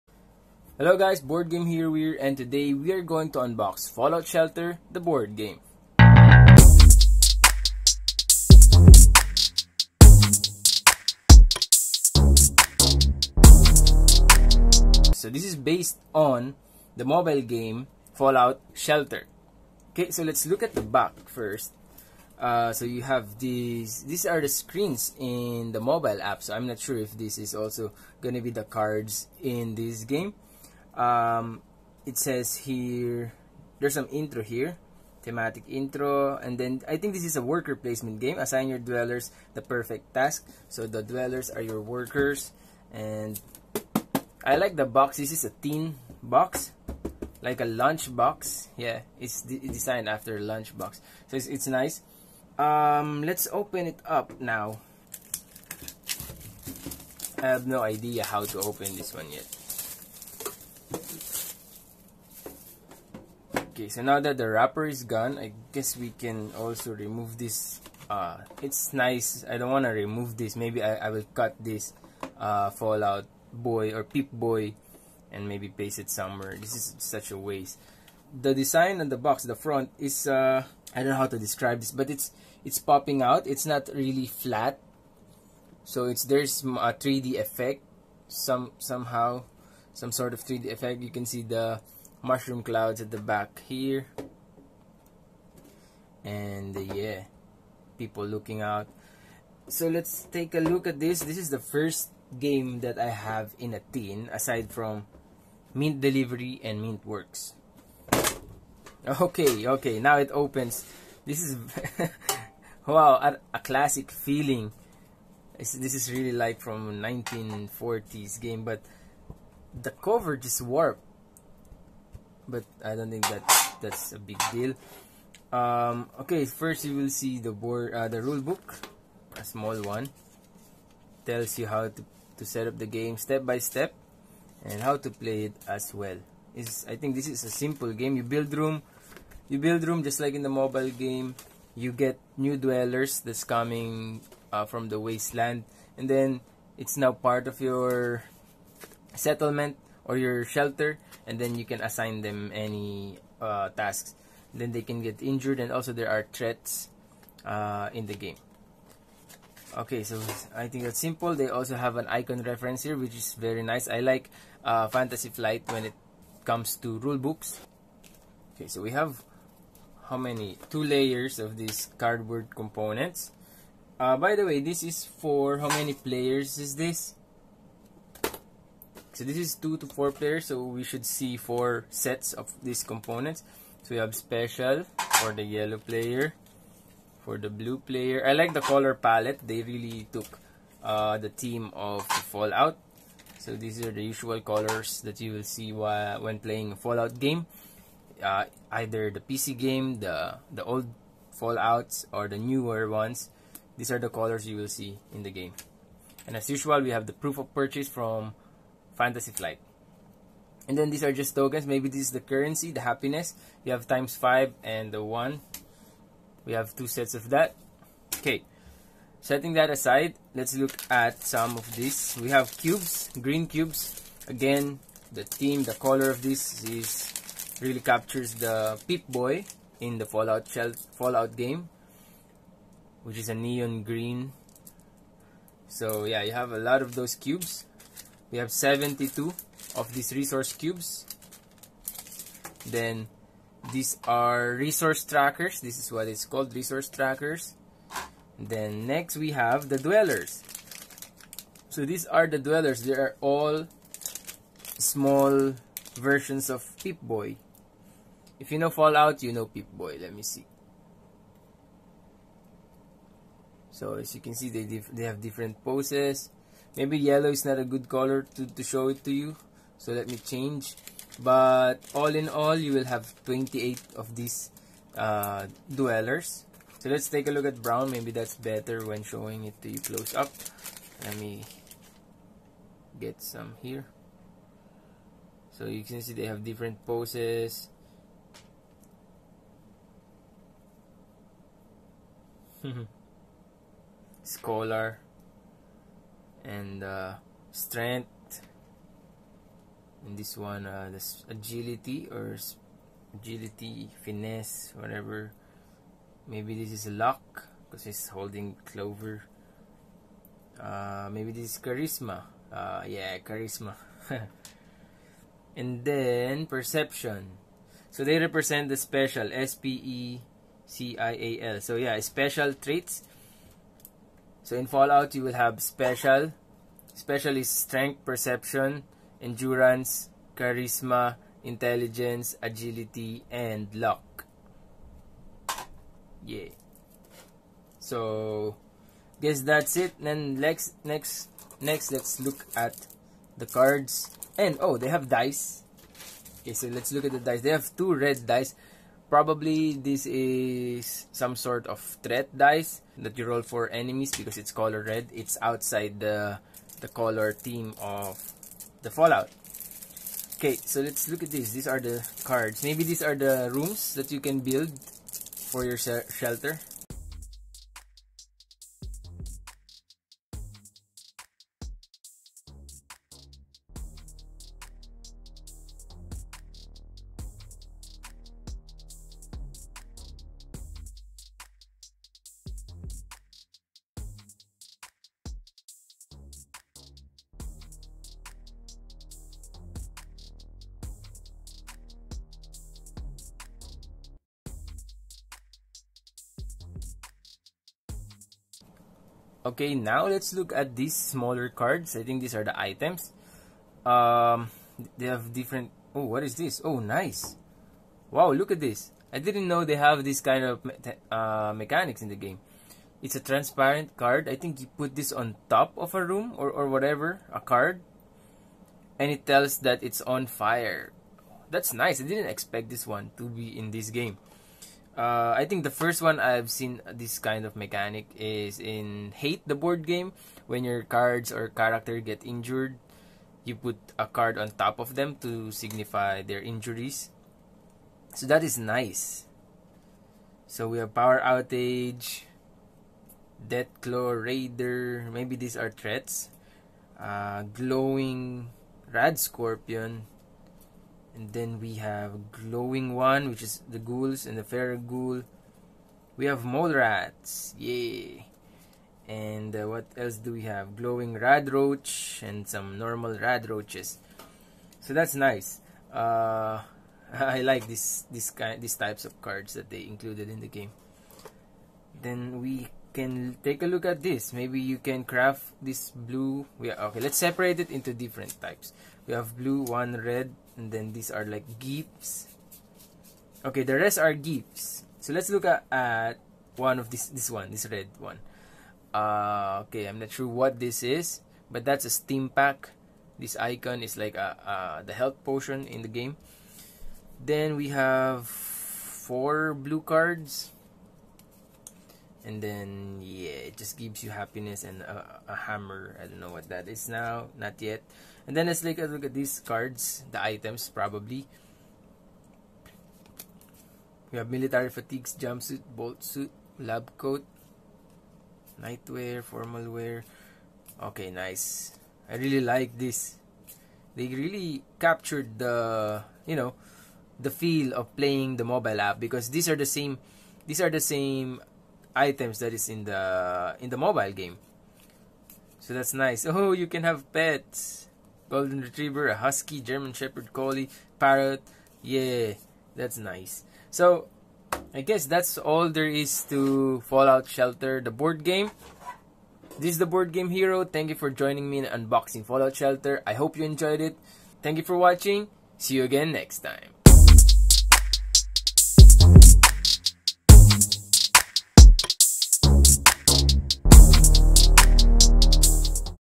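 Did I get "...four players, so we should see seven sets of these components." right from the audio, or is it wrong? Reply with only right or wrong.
wrong.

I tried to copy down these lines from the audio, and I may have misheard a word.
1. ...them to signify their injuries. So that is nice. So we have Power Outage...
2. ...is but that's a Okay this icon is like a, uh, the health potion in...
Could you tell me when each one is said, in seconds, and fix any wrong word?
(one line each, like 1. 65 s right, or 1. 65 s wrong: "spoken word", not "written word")
1. 434 s right
2. 490 s wrong: "Stimpak", not "Okay".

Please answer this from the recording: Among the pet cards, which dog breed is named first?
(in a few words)
Golden retriever.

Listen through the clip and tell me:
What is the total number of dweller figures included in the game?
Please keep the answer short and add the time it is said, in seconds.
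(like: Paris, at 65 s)
28, at 273 s.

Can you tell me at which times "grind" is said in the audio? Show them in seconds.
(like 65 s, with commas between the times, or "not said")
not said.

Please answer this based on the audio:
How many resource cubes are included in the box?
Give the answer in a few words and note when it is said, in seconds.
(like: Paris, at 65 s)
72, at 238 s.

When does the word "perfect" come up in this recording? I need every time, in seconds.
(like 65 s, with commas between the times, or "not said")
39 s.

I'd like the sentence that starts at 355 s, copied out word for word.
It's outside the, the color theme of the Fallout.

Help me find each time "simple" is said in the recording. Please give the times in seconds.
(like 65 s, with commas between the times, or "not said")
137 s, 160 s.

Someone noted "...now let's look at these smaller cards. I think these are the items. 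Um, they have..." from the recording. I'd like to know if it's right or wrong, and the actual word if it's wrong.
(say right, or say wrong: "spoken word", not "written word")
right.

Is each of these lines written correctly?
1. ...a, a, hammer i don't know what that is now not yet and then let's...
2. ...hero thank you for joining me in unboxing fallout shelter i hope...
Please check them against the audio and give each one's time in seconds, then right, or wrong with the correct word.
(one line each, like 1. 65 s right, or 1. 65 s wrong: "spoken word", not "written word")
1. 504 s right
2. 550 s right.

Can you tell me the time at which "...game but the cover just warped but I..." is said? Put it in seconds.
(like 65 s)
118 s.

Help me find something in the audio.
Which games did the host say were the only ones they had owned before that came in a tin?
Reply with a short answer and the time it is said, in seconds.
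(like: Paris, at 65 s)
Mint Delivery and Mint Works, at 105 s.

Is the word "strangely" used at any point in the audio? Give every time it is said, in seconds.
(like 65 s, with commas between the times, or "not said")
not said.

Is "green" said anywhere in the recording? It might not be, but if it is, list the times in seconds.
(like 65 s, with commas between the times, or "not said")
223 s, 233 s.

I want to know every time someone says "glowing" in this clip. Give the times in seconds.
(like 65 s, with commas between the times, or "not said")
447 s, 452 s, 460 s.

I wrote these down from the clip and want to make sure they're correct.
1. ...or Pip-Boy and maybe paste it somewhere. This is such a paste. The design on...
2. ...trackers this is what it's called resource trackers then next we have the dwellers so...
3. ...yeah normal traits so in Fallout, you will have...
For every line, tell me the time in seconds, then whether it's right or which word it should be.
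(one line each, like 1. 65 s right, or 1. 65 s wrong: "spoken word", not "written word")
1. 73 s wrong: "waste", not "paste"
2. 245 s right
3. 321 s wrong: "special", not "normal".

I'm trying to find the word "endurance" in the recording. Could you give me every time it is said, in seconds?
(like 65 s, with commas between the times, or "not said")
329 s.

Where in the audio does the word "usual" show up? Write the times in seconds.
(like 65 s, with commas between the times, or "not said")
194 s, 206 s.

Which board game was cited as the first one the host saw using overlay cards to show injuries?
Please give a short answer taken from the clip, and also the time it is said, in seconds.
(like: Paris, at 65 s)
Hate, at 429 s.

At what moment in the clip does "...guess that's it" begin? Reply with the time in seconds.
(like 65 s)
339 s.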